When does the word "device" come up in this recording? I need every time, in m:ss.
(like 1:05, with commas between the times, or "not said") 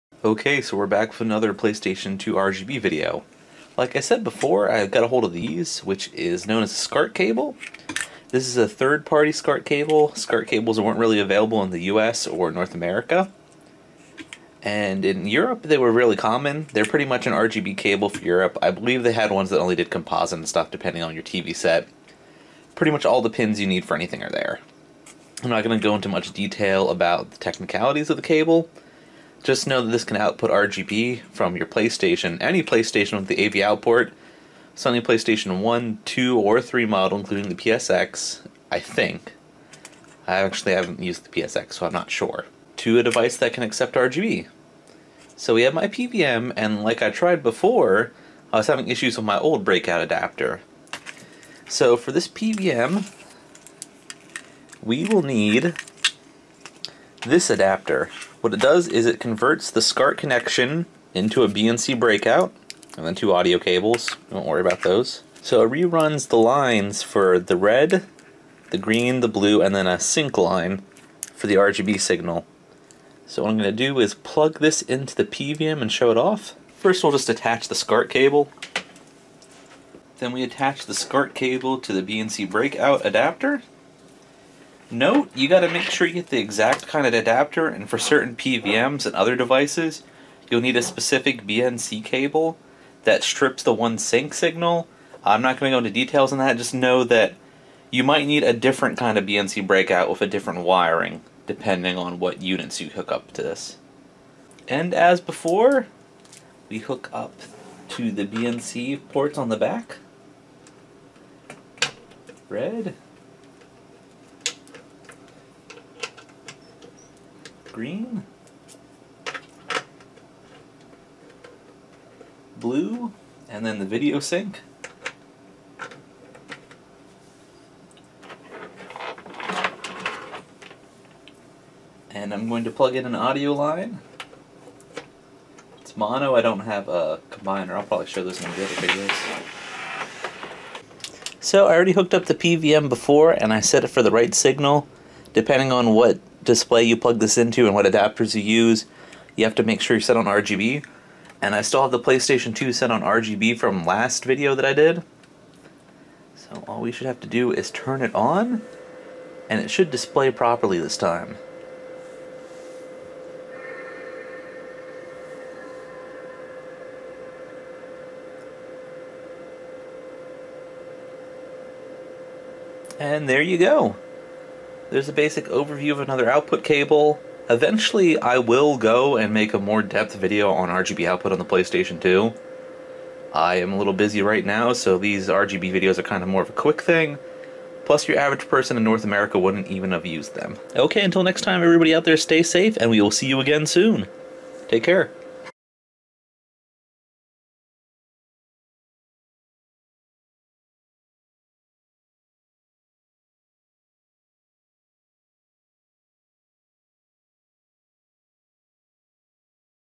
0:43, 1:29.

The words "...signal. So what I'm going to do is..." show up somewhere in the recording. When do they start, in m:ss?
1:11.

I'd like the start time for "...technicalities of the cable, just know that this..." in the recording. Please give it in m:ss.
0:27.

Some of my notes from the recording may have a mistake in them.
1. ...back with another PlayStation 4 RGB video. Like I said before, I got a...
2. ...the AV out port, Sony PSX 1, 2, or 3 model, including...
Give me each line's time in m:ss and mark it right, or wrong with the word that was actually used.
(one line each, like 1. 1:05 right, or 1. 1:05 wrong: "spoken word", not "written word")
1. 0:00 wrong: "2", not "4"
2. 0:33 wrong: "PlayStation", not "PSX".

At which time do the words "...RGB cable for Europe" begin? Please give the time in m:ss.
0:17.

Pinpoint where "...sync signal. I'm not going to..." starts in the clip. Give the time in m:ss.
1:33.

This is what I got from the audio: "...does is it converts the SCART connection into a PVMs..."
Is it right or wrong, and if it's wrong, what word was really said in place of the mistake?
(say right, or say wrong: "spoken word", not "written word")
wrong: "BNC", not "PVMs".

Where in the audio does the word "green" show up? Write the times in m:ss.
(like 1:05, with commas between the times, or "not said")
1:08, 1:57.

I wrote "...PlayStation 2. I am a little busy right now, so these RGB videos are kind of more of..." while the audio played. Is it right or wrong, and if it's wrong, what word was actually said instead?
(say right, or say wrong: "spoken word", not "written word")
right.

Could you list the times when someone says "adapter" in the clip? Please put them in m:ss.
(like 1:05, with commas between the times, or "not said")
0:50, 0:57, 1:23, 1:27, 2:27.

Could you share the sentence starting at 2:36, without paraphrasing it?
So all we should have to do is turn it on and it should display properly this time.